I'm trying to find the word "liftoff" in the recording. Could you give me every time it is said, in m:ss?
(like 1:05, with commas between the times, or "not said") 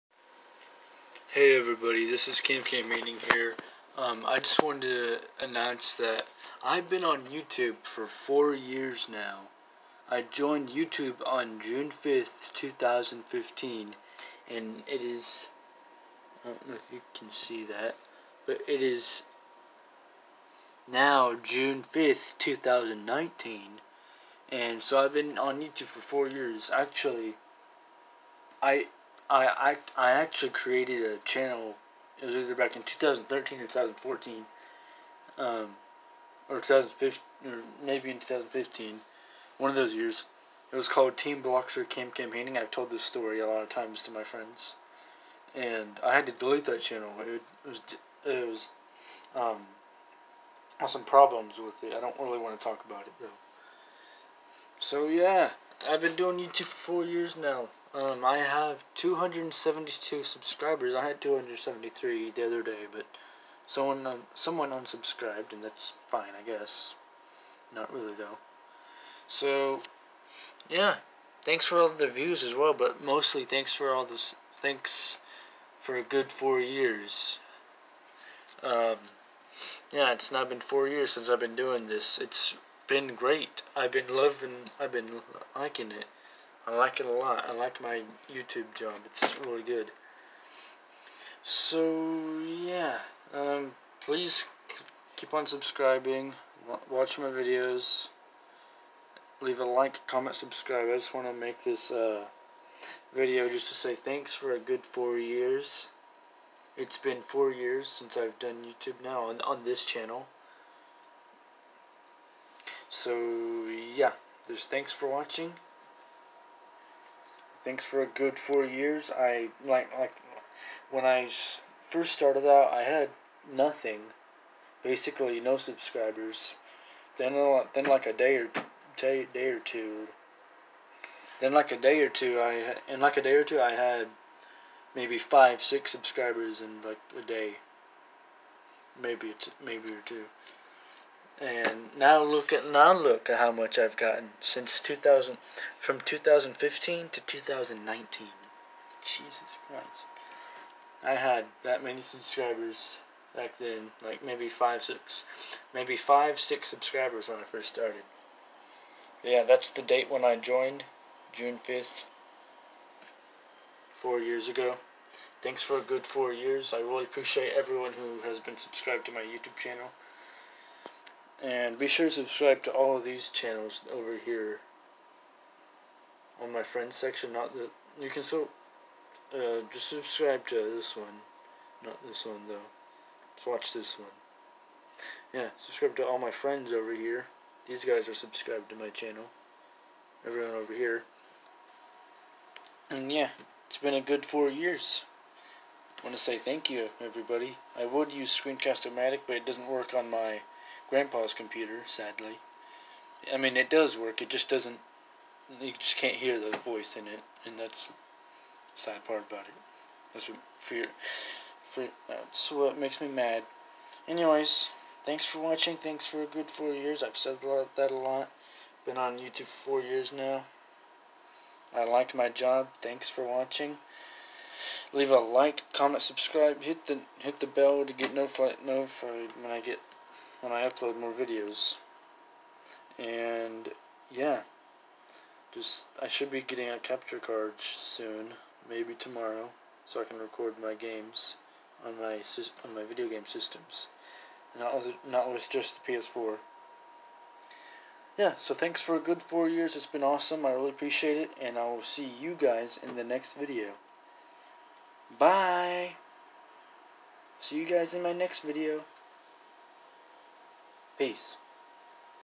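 not said.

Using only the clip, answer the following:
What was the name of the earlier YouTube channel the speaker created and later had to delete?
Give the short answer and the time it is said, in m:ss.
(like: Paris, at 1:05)
Team Blocks Camp Campaigning, at 0:41.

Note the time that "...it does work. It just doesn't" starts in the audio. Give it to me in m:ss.
3:23.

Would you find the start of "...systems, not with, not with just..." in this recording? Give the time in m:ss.
4:03.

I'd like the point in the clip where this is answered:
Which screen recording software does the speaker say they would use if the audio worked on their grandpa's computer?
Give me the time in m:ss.
3:18.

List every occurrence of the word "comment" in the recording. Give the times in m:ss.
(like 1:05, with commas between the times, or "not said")
1:40, 3:45.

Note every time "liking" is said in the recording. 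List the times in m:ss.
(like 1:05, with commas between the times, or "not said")
1:25.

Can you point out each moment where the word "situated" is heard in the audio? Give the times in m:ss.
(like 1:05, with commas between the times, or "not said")
not said.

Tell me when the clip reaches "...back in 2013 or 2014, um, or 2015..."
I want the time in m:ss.
0:32.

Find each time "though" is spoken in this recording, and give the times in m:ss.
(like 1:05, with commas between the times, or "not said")
0:53, 1:08, 3:02.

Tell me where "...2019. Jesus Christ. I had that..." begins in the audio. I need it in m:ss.
2:27.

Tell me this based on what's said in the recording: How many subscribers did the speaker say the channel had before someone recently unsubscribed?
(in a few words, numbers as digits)
273.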